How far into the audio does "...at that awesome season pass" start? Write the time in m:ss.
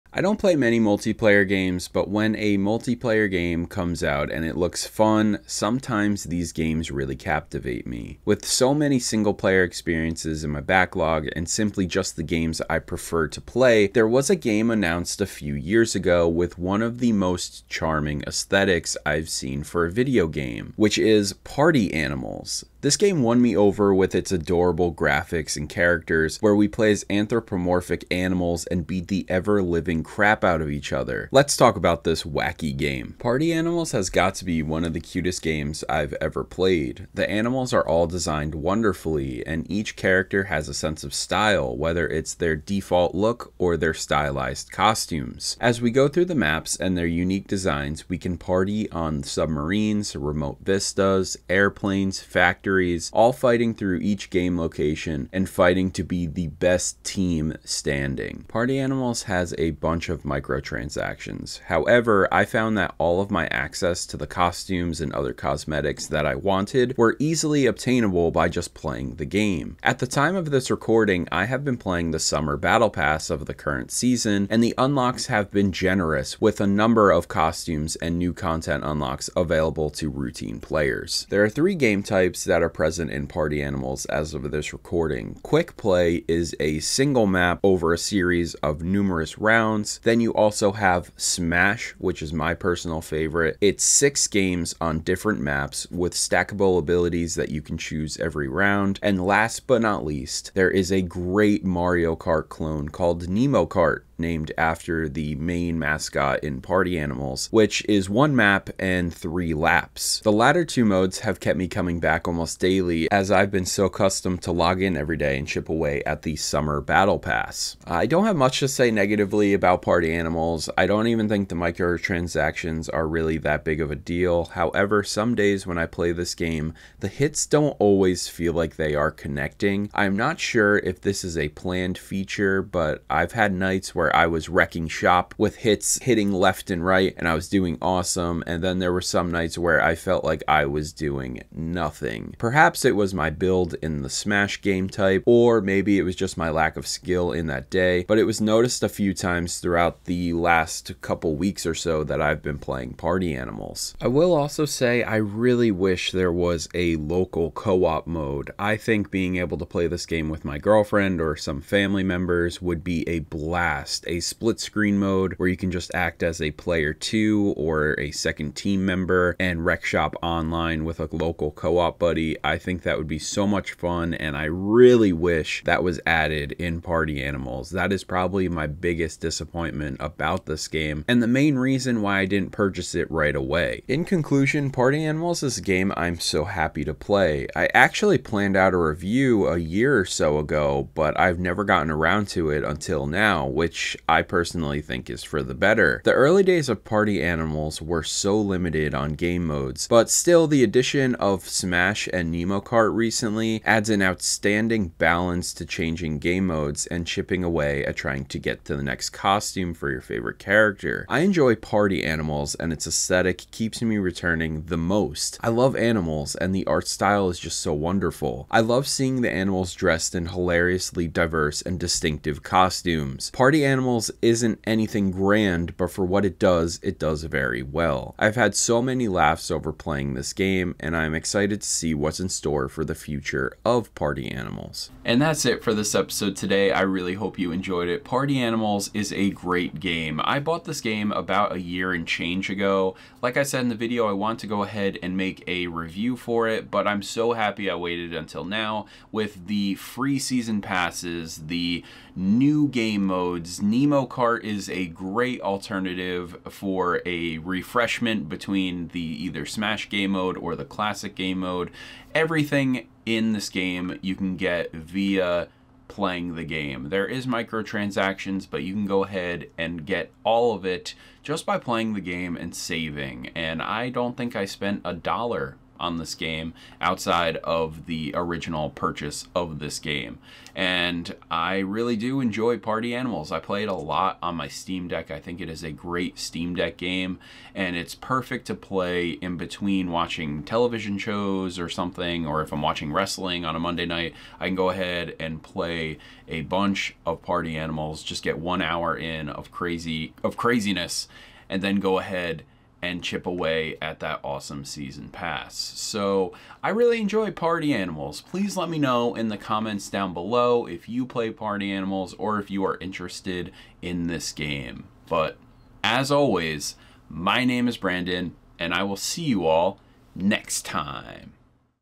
5:03.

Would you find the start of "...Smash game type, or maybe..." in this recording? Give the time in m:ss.
2:24.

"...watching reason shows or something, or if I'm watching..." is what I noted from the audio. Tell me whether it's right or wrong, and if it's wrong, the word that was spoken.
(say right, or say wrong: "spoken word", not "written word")
wrong: "television", not "reason".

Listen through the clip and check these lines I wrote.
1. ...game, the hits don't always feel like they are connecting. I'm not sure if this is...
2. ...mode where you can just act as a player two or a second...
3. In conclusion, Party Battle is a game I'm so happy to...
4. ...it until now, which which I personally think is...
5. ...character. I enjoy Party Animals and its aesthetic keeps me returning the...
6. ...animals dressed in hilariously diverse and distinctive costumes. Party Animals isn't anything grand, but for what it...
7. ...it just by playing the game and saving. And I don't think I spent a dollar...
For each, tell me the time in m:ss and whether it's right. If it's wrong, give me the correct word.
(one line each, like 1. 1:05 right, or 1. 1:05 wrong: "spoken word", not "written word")
1. 2:06 right
2. 2:44 right
3. 3:03 wrong: "Animals", not "Battle"
4. 3:12 right
5. 3:30 right
6. 3:39 right
7. 4:30 right.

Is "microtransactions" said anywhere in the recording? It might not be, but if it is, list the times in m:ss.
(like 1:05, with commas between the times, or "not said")
1:00, 2:01, 4:27.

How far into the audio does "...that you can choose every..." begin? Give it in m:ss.
1:37.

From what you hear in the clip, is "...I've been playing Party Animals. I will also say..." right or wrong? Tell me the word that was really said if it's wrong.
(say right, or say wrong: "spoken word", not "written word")
right.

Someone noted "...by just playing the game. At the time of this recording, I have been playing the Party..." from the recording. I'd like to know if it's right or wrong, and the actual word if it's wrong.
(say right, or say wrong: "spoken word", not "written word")
wrong: "Summer", not "Party".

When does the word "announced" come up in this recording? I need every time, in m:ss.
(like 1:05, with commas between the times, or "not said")
0:14.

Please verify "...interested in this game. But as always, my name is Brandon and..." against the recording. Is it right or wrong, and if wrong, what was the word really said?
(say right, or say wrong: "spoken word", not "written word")
right.